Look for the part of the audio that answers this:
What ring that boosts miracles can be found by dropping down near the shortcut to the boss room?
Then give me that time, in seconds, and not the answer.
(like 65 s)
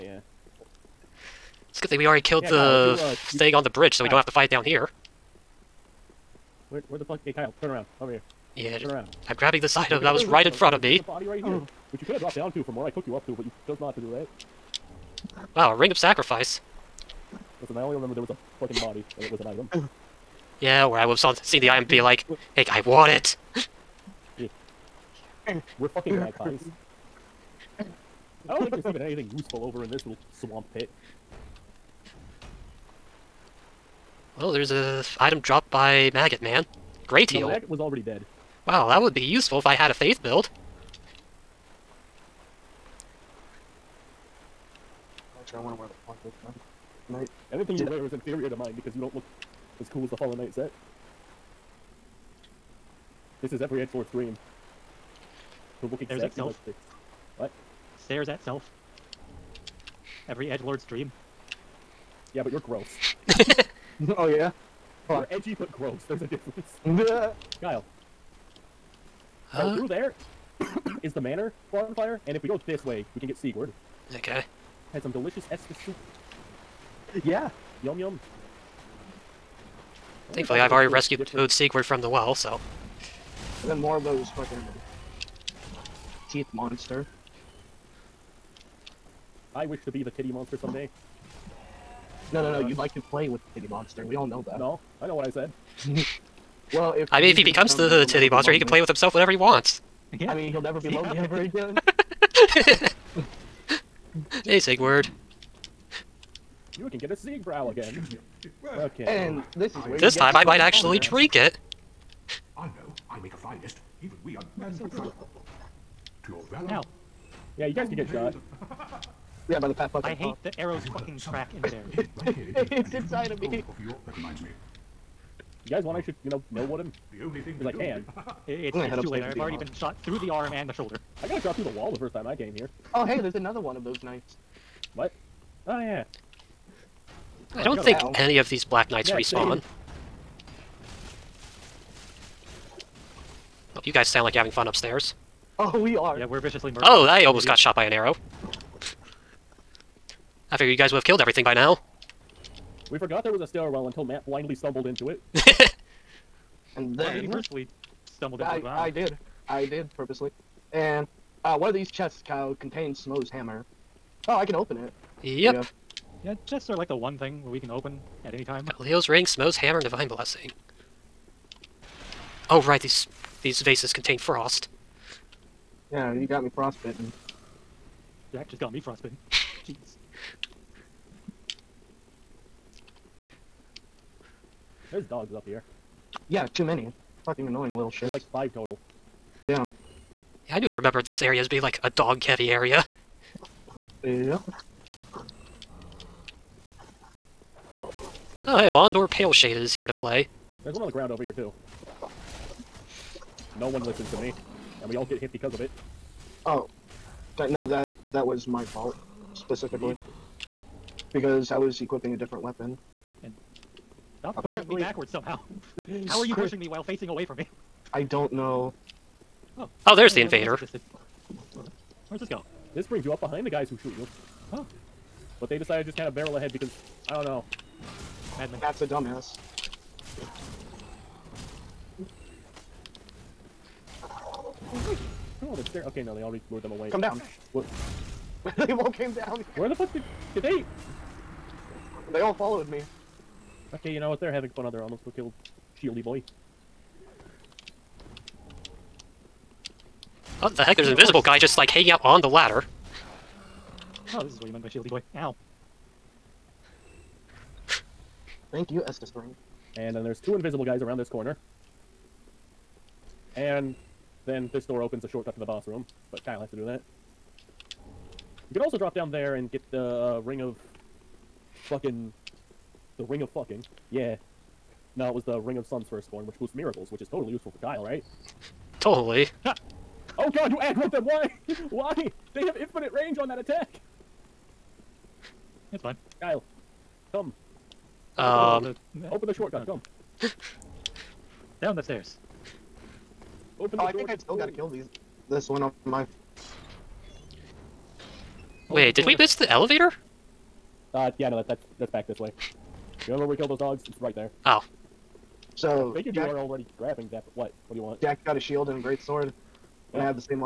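275 s.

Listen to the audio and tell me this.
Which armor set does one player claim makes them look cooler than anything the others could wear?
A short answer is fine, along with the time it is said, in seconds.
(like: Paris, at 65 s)
Fallen Knight set, at 50 s.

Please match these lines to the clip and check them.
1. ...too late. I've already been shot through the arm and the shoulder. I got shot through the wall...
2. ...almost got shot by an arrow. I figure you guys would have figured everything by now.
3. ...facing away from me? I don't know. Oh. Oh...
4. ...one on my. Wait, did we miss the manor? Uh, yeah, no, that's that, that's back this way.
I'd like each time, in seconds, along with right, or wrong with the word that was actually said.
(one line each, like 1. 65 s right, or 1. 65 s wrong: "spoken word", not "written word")
1. 129 s right
2. 147 s wrong: "killed", not "figured"
3. 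216 s right
4. 295 s wrong: "elevator", not "manor".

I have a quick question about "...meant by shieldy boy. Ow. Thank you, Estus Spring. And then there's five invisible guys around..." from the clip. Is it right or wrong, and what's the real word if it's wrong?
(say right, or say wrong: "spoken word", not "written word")
wrong: "two", not "five".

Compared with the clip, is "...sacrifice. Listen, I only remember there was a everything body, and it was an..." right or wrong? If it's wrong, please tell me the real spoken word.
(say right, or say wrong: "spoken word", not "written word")
wrong: "fucking", not "everything".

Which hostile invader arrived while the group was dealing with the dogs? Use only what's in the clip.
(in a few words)
Londor Pale Shade.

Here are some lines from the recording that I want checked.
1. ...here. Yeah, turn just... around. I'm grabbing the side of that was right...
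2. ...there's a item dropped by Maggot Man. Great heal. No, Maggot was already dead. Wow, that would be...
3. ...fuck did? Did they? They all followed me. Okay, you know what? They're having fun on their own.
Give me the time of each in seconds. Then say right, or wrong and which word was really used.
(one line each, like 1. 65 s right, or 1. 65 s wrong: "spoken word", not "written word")
1. 8 s right
2. 34 s right
3. 239 s right.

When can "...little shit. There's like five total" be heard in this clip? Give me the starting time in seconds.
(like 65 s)
187 s.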